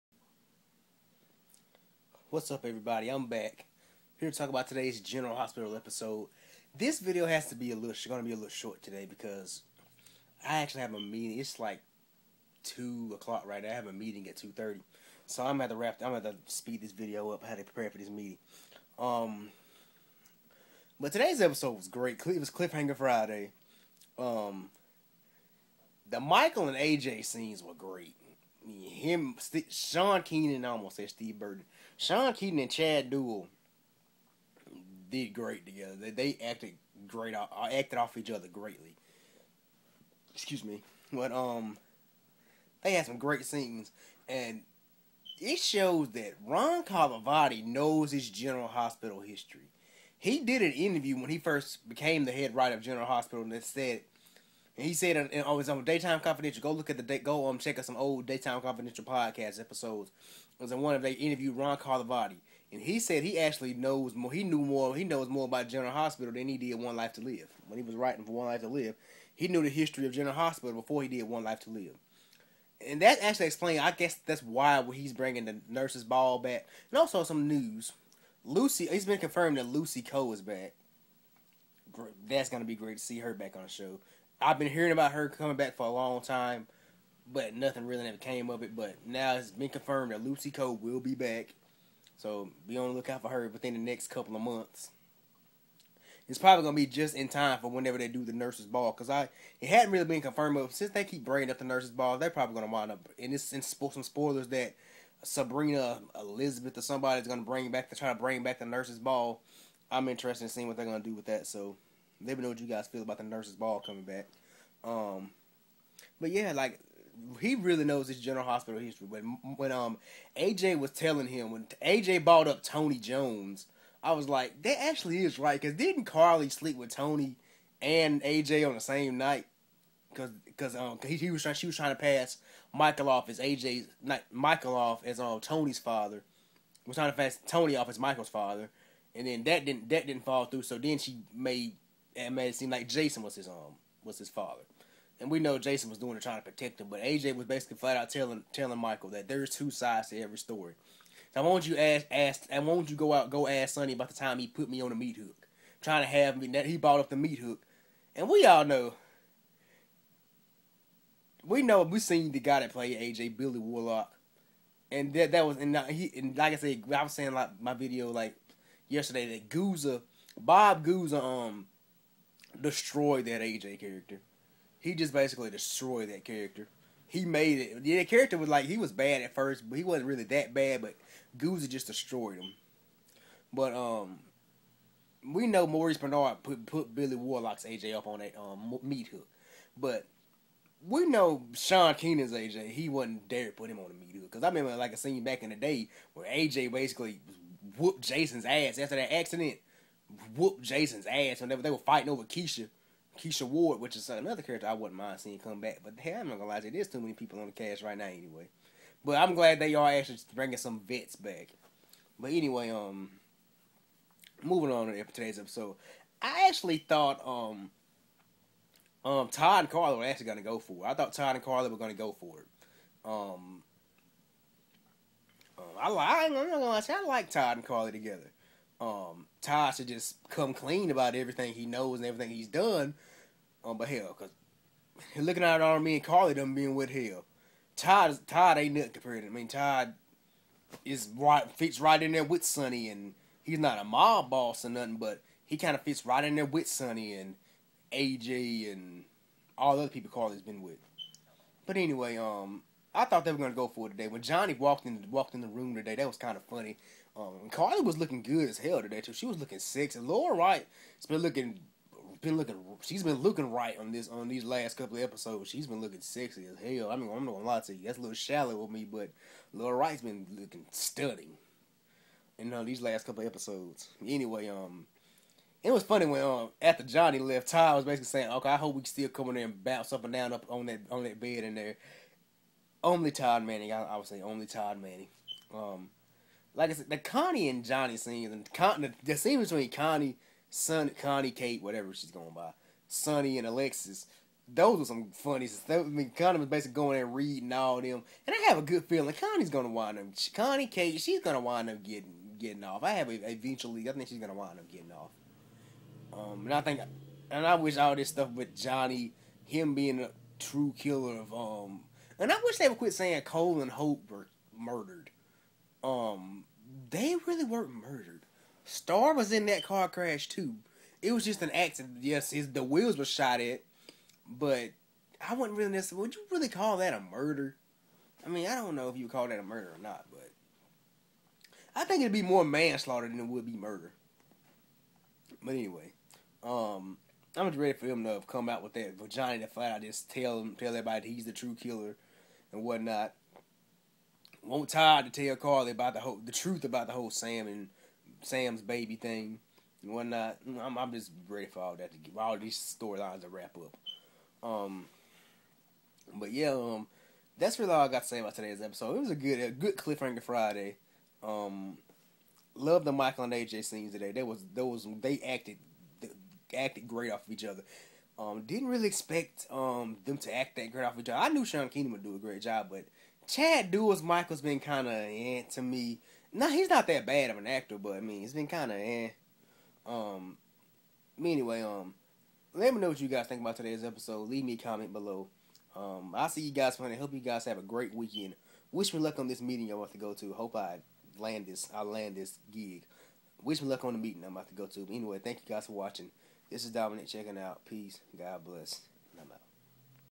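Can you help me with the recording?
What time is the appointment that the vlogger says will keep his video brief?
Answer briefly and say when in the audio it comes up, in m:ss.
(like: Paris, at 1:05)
2:30, at 0:14.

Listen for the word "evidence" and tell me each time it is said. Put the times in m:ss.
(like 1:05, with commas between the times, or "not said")
not said.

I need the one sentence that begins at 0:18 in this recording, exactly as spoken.
Um, but today's episode was great.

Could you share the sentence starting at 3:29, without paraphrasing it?
But I'm glad they are actually bringing some vets back.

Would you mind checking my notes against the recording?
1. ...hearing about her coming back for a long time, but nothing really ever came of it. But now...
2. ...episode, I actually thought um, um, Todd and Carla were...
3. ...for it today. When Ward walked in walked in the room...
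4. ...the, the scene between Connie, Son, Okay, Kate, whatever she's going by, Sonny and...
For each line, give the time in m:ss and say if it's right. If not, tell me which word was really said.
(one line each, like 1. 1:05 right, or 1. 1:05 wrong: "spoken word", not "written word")
1. 1:24 right
2. 3:35 right
3. 4:13 wrong: "Johnny", not "Ward"
4. 4:48 wrong: "Connie", not "Okay".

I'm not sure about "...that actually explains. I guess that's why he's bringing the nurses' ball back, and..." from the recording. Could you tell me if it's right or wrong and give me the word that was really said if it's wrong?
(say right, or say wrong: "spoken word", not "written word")
right.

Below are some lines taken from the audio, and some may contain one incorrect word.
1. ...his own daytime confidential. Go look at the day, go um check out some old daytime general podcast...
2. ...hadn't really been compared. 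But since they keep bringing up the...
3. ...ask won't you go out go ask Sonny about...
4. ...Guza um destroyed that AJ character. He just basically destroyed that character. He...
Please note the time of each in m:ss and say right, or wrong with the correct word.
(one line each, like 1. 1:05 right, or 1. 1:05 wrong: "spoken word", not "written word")
1. 0:55 wrong: "confidential", not "general"
2. 1:39 wrong: "confirmed", not "compared"
3. 2:32 right
4. 2:50 right.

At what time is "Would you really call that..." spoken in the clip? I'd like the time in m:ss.
5:26.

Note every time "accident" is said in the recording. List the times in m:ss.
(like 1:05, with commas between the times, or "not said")
3:19, 5:21.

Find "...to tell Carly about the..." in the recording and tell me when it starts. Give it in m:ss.
5:45.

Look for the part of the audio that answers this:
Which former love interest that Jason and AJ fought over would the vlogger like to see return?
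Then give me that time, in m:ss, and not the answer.
3:23.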